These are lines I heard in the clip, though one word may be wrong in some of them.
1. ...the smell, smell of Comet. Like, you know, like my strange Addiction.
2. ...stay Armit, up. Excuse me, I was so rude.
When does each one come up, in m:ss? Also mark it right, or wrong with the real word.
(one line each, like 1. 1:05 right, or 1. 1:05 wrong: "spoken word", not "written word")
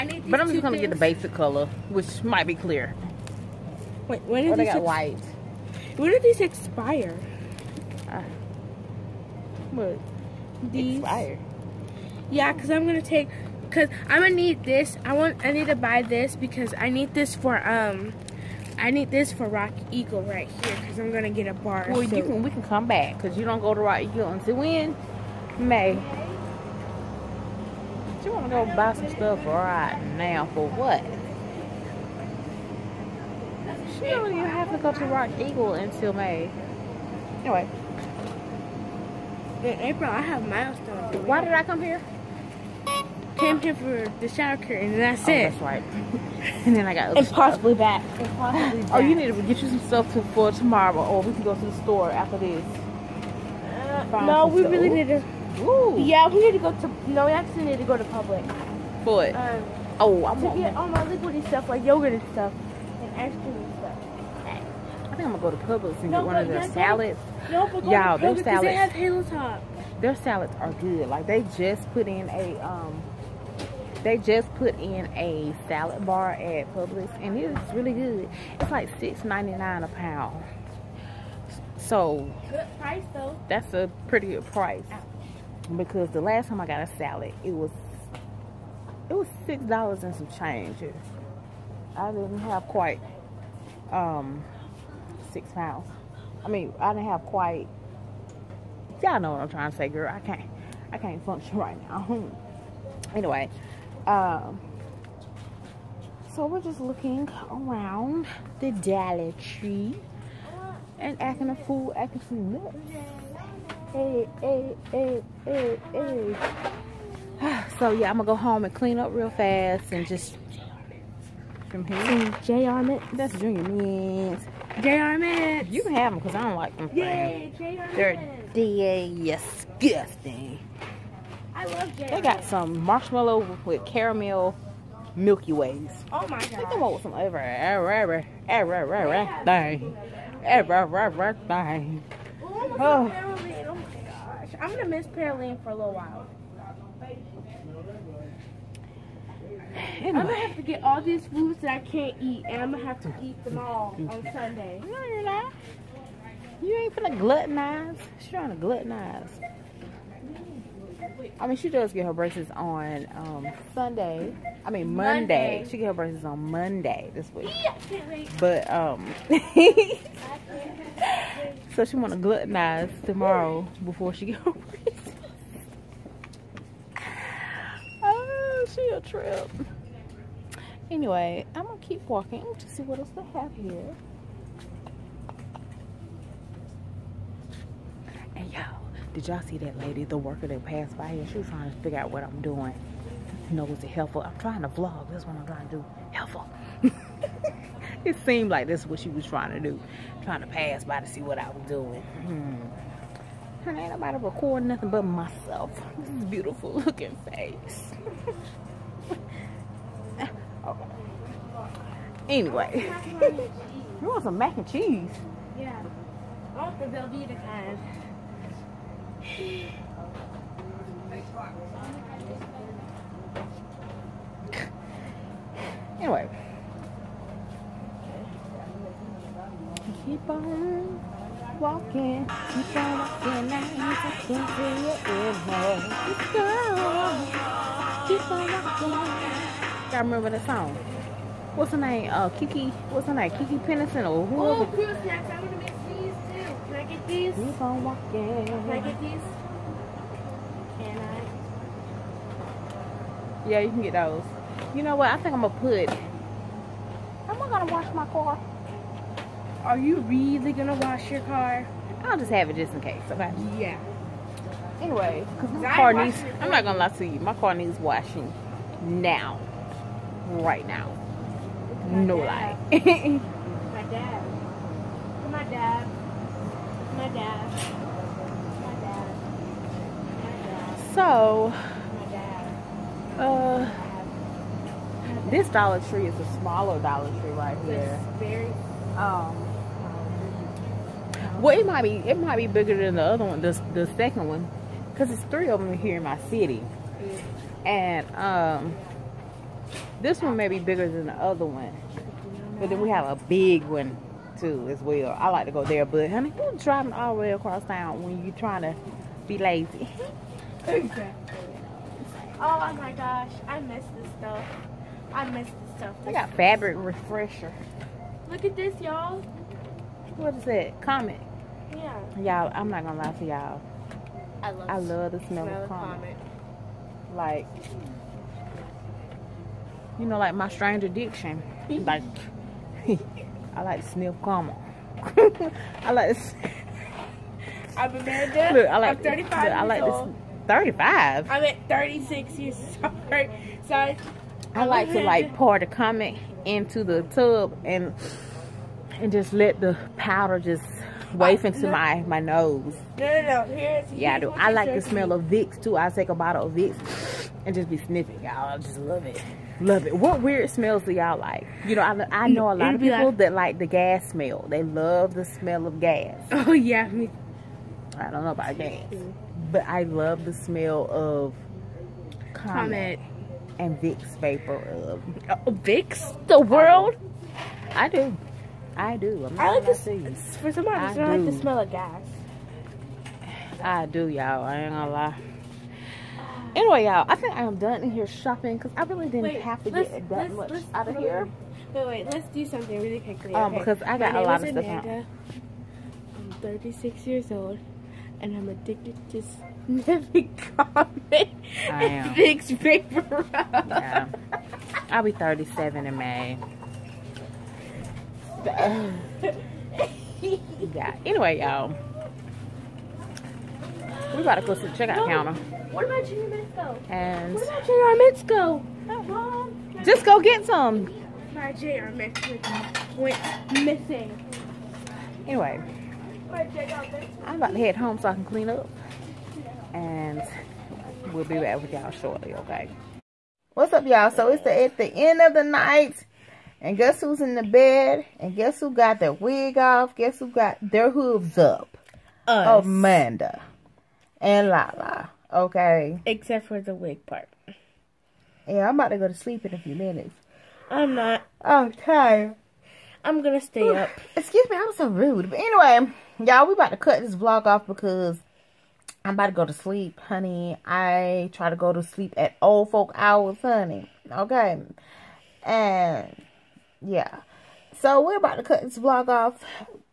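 1. 5:25 right
2. 7:33 wrong: "Ooh", not "Armit".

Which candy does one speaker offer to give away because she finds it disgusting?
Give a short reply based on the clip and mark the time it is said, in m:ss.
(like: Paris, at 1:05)
Junior Mints, at 2:03.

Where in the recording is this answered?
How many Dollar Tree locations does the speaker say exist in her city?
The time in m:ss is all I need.
4:55.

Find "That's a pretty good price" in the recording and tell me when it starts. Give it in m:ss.
1:23.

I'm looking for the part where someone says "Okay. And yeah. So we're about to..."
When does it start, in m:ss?
7:44.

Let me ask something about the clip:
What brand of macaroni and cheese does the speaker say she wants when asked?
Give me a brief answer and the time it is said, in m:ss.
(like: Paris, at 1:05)
Velveeta, at 3:36.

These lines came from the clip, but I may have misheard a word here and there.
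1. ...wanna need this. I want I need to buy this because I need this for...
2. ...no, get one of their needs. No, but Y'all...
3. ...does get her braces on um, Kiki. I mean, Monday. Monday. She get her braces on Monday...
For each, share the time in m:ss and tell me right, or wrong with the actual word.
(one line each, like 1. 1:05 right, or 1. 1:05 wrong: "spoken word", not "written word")
1. 0:14 wrong: "gonna", not "wanna"
2. 1:06 wrong: "salads", not "needs"
3. 2:41 wrong: "Sunday", not "Kiki".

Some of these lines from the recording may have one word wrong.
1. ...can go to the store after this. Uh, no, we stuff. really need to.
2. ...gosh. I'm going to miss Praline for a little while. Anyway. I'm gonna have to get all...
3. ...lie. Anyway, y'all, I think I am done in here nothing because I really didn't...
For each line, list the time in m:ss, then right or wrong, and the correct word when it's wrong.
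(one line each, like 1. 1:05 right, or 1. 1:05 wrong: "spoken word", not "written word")
1. 0:51 right
2. 2:24 right
3. 6:24 wrong: "shopping", not "nothing".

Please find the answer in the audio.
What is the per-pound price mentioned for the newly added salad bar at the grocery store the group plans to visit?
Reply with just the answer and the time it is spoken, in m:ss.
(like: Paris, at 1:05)
$6.99, at 1:18.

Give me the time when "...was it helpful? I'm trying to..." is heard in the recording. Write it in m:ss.
3:13.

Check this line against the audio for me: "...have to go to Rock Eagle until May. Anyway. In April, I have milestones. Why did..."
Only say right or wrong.
right.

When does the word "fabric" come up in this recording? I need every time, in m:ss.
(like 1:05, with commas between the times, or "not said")
5:16.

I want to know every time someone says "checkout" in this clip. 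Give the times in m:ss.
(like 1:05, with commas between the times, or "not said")
6:54.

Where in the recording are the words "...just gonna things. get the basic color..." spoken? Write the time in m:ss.
0:00.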